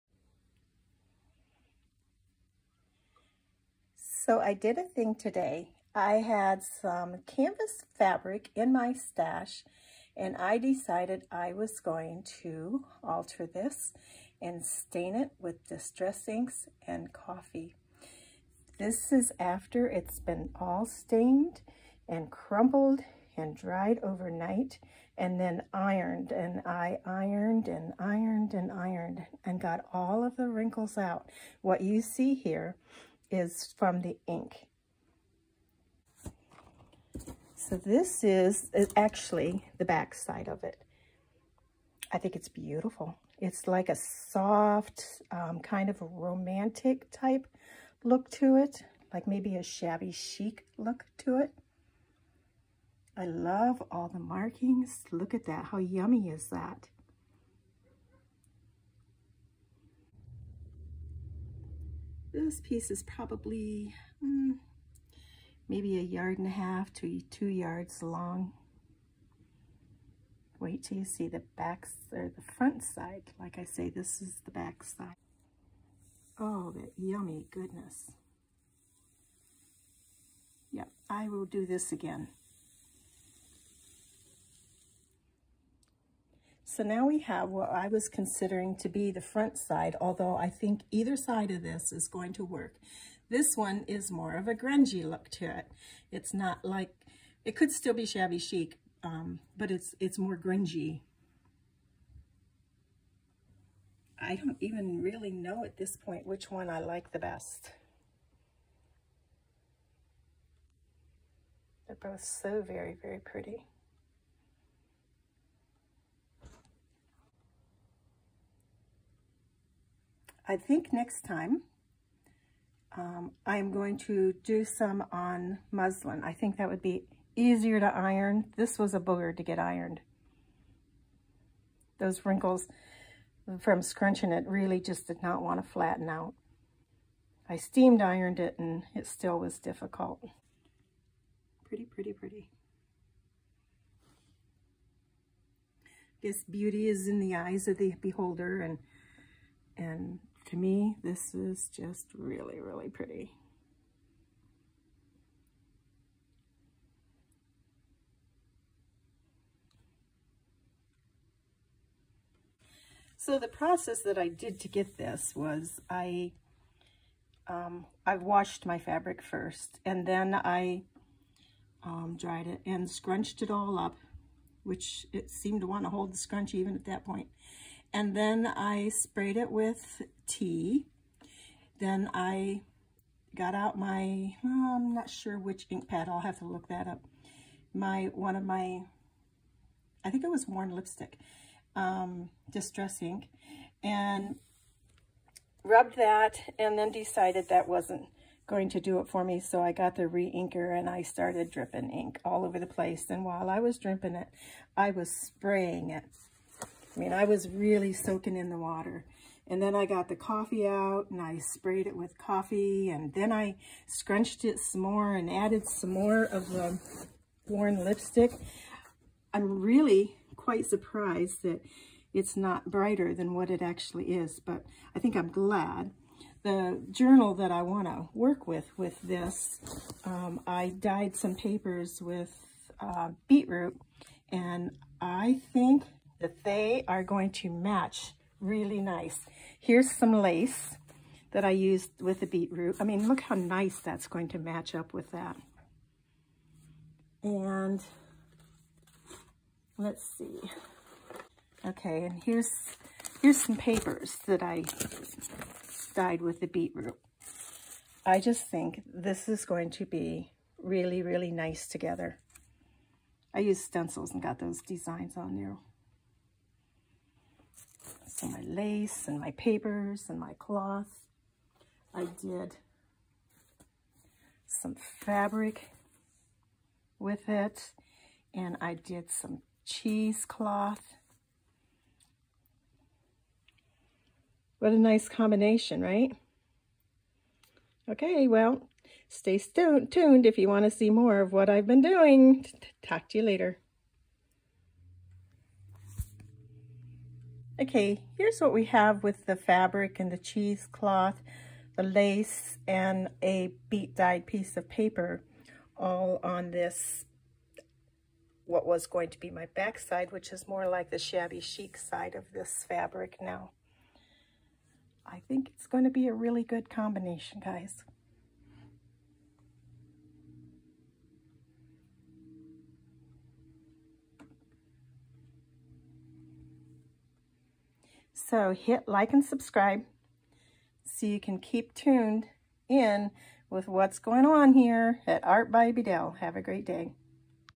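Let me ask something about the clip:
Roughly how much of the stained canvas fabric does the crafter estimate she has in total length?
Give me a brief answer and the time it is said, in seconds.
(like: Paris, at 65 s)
1.5 to 2 yards, at 65 s.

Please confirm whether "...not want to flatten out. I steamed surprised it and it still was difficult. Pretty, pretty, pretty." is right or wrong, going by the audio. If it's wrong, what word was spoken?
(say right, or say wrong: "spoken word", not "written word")
wrong: "ironed", not "surprised".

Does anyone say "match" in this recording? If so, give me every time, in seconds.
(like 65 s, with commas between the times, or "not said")
237 s, 244 s.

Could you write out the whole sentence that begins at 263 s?
I used stencils and got those designs on there and my lace and my papers and my cloth.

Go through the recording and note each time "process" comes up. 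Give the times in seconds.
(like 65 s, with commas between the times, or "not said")
163 s.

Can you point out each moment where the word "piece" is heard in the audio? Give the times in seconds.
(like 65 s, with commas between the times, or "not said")
62 s, 304 s.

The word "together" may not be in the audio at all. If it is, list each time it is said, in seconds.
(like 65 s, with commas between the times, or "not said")
261 s.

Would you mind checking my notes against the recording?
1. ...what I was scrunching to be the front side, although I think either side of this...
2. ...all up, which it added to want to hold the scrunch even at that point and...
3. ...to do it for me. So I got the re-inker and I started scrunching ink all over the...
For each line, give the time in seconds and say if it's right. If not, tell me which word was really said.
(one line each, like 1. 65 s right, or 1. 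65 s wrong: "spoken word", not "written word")
1. 87 s wrong: "considering", not "scrunching"
2. 173 s wrong: "seemed", not "added"
3. 198 s wrong: "dripping", not "scrunching".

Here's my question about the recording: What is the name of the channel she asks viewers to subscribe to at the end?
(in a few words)
Art by BDell.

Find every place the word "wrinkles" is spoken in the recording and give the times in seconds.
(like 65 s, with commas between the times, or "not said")
30 s, 132 s.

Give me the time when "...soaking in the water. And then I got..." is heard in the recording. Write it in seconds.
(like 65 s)
207 s.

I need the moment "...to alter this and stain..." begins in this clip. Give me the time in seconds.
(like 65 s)
12 s.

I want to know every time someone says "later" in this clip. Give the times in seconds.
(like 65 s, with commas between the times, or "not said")
293 s.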